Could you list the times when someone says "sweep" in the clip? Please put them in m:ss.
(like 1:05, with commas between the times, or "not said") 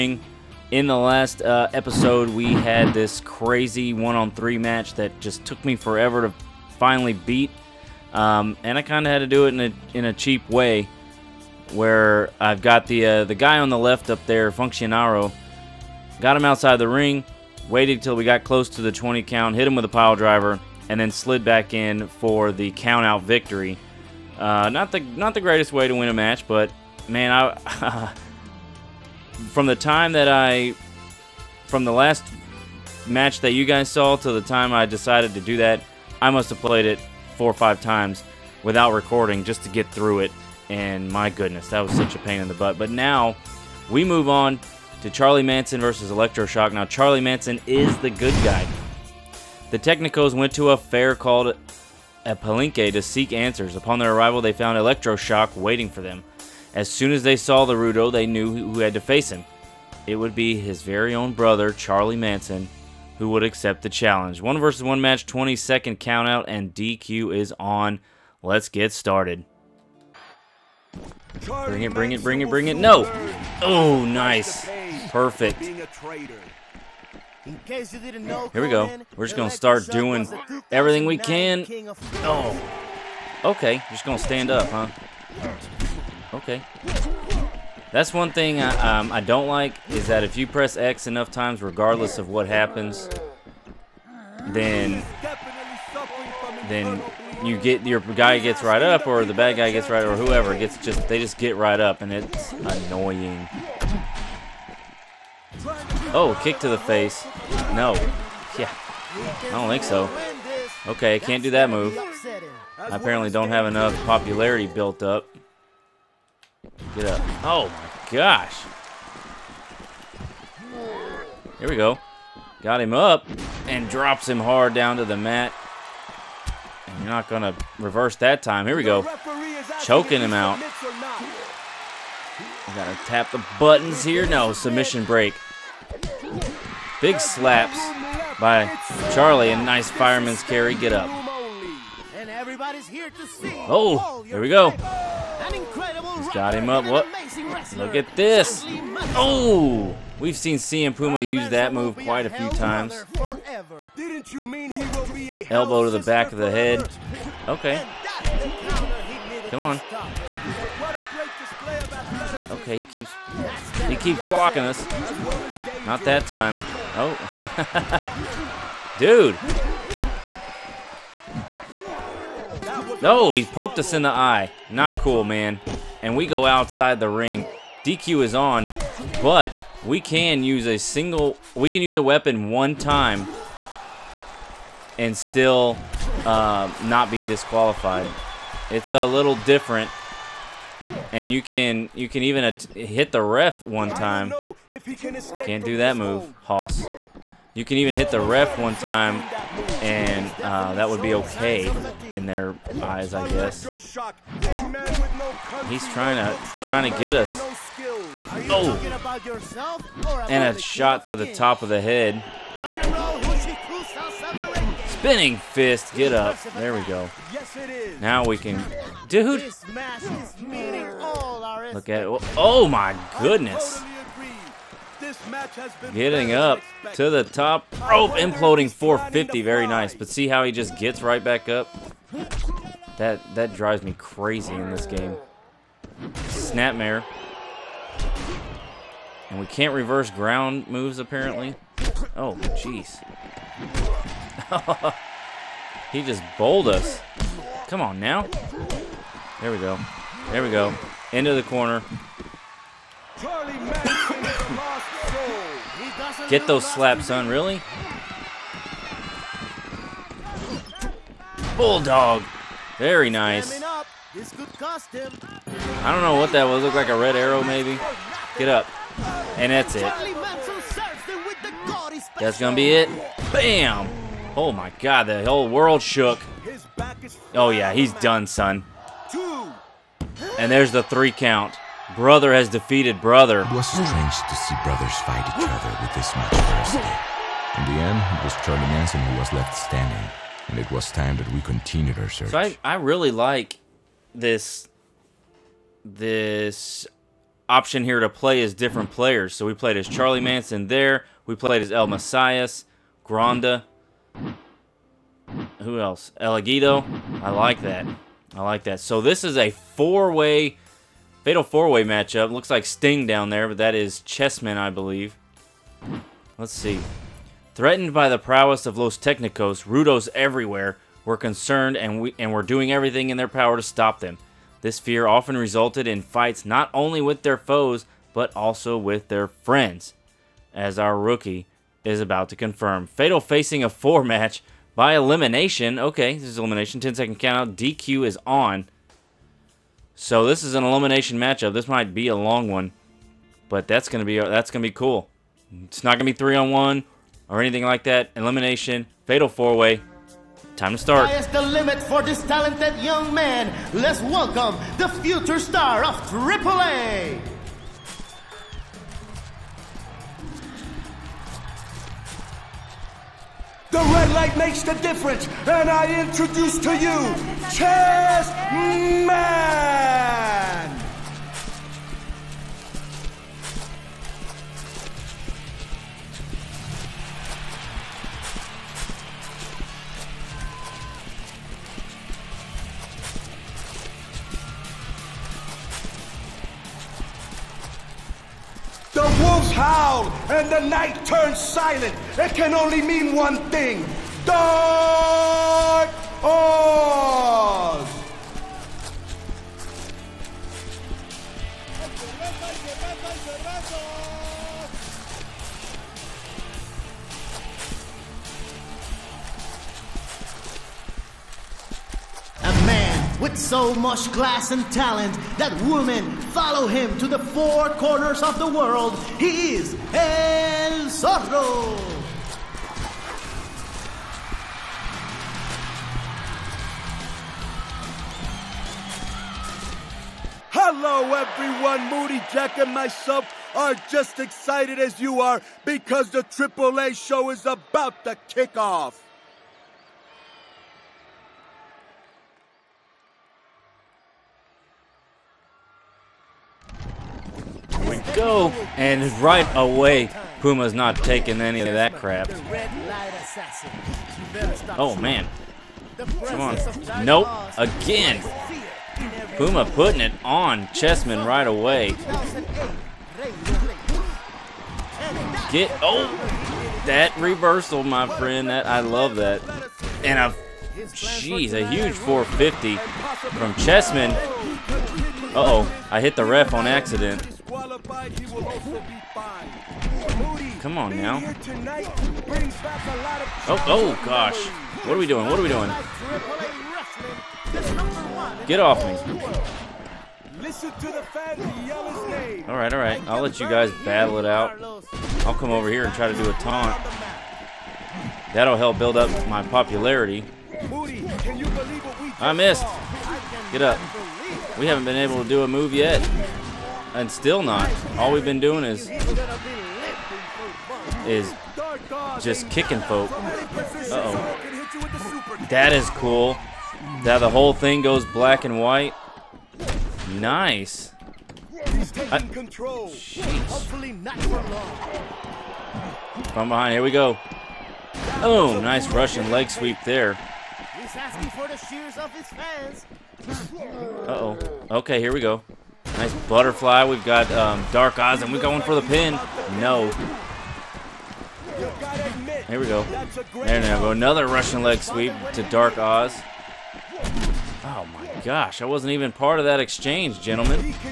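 8:49, 9:04.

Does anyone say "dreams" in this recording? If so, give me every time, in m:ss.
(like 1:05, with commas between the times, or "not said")
not said.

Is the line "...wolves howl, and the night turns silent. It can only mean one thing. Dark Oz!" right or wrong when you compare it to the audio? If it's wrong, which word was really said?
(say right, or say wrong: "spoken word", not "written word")
right.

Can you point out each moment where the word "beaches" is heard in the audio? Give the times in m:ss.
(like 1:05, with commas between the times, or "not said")
not said.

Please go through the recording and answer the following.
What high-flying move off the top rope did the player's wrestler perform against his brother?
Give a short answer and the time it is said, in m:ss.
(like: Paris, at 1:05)
Imploding 450, at 3:48.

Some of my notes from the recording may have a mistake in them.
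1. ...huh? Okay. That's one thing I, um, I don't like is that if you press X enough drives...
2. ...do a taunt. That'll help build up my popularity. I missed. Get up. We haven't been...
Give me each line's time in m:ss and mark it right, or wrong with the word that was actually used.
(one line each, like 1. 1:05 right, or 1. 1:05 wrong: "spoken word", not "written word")
1. 1:24 wrong: "times", not "drives"
2. 8:16 right.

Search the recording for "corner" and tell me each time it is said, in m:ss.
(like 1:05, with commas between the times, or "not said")
4:11, 6:57.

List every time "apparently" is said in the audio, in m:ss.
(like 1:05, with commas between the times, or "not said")
1:52, 4:00.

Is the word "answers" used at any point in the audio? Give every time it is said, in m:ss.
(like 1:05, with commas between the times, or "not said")
0:53.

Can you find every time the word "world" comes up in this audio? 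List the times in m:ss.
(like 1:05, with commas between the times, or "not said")
4:35, 6:58.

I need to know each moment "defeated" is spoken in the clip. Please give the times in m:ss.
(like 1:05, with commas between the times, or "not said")
4:42.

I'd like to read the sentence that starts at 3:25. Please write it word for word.
He's trying to trying to get us.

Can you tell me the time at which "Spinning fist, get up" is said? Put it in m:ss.
3:34.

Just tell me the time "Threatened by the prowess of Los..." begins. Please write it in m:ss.
5:17.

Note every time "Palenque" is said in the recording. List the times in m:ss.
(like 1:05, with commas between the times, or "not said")
0:52.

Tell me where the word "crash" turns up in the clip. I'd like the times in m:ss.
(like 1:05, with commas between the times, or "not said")
not said.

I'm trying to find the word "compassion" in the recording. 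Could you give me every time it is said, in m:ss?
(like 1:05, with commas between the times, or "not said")
not said.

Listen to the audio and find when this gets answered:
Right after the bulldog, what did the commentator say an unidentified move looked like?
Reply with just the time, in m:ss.
4:26.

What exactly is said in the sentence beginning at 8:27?
All we've been doing is is just kicking folk.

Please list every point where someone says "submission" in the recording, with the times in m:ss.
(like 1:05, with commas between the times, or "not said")
2:14.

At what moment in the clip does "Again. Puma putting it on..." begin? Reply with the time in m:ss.
7:37.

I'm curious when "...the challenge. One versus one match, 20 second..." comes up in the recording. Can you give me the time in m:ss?
1:03.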